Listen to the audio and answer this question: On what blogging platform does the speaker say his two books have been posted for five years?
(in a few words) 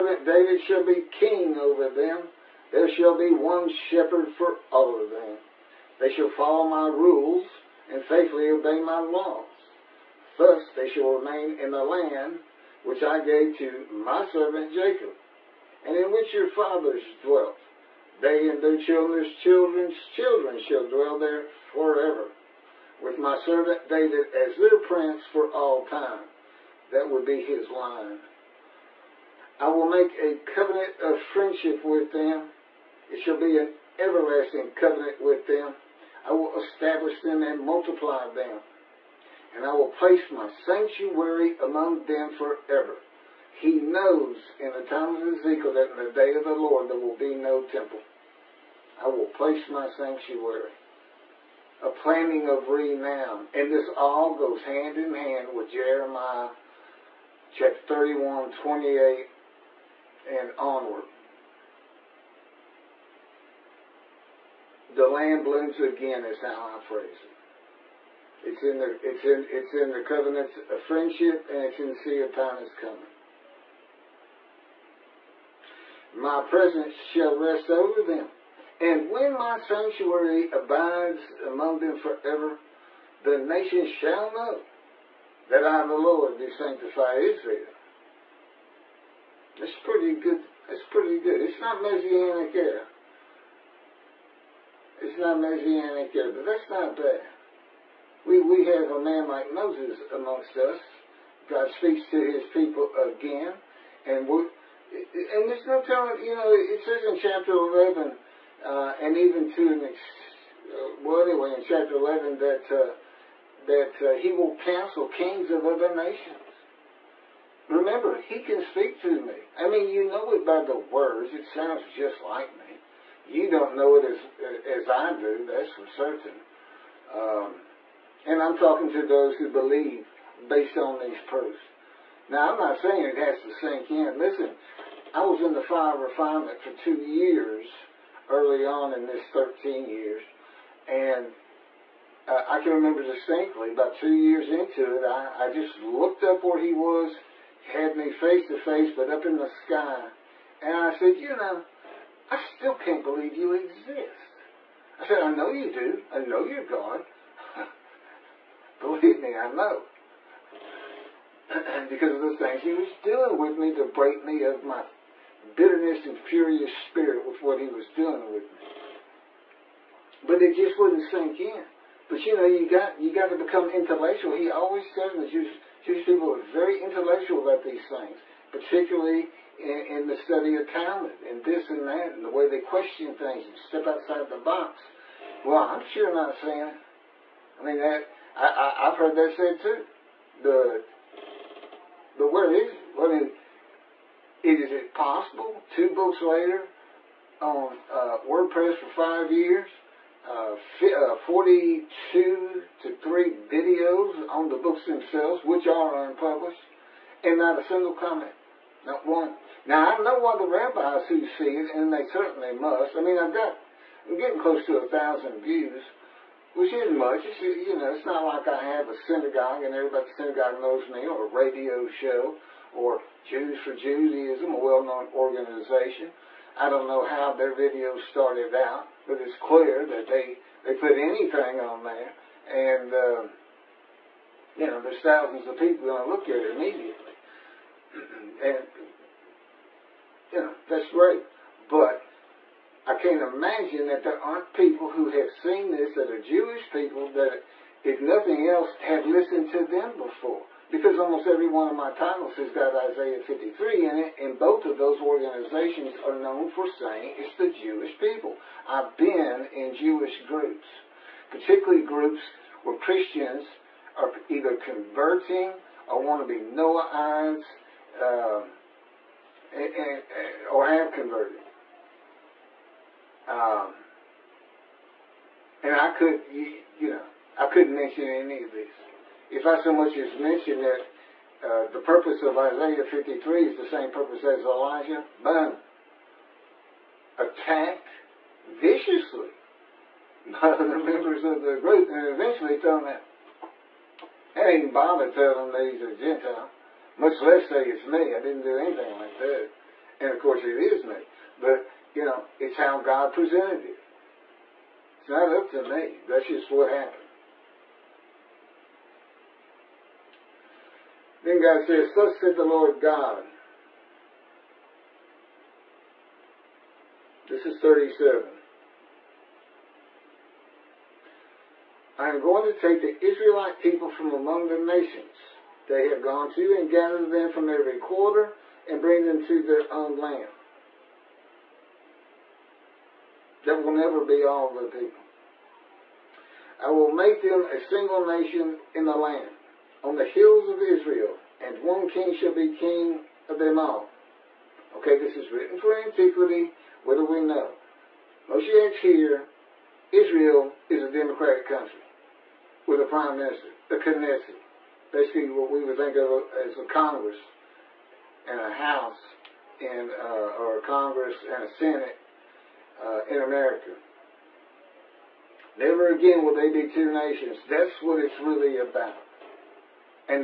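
WordPress.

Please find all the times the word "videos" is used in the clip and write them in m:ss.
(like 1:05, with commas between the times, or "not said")
3:23, 3:47.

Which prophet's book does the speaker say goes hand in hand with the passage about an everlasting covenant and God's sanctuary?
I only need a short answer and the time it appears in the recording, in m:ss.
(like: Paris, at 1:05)
Jeremiah, at 0:55.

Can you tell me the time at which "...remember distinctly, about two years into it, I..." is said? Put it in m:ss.
2:22.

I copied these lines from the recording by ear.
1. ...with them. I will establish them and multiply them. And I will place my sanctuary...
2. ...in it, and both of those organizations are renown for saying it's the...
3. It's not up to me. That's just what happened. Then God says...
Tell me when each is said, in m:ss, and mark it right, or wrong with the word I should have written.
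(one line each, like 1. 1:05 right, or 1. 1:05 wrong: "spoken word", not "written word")
1. 0:35 right
2. 4:13 wrong: "known", not "renown"
3. 5:04 right.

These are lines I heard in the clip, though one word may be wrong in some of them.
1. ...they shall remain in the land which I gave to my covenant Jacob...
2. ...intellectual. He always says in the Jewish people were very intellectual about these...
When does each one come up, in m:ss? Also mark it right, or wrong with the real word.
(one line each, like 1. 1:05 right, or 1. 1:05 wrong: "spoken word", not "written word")
1. 0:10 wrong: "servant", not "covenant"
2. 2:53 right.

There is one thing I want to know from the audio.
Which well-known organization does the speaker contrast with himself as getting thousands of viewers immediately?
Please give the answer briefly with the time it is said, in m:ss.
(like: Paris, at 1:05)
Jews for Judaism, at 3:43.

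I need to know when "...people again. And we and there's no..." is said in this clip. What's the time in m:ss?
1:42.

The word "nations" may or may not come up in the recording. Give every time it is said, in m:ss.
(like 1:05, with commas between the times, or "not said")
1:23, 1:55, 5:24, 5:38, 6:06.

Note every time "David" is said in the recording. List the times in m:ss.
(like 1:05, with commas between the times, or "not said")
0:00, 0:23.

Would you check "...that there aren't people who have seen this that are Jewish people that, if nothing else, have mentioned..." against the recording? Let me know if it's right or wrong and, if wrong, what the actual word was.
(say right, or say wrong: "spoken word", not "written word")
wrong: "listened", not "mentioned".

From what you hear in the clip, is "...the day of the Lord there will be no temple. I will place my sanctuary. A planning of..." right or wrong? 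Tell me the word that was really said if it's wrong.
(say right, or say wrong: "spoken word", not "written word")
right.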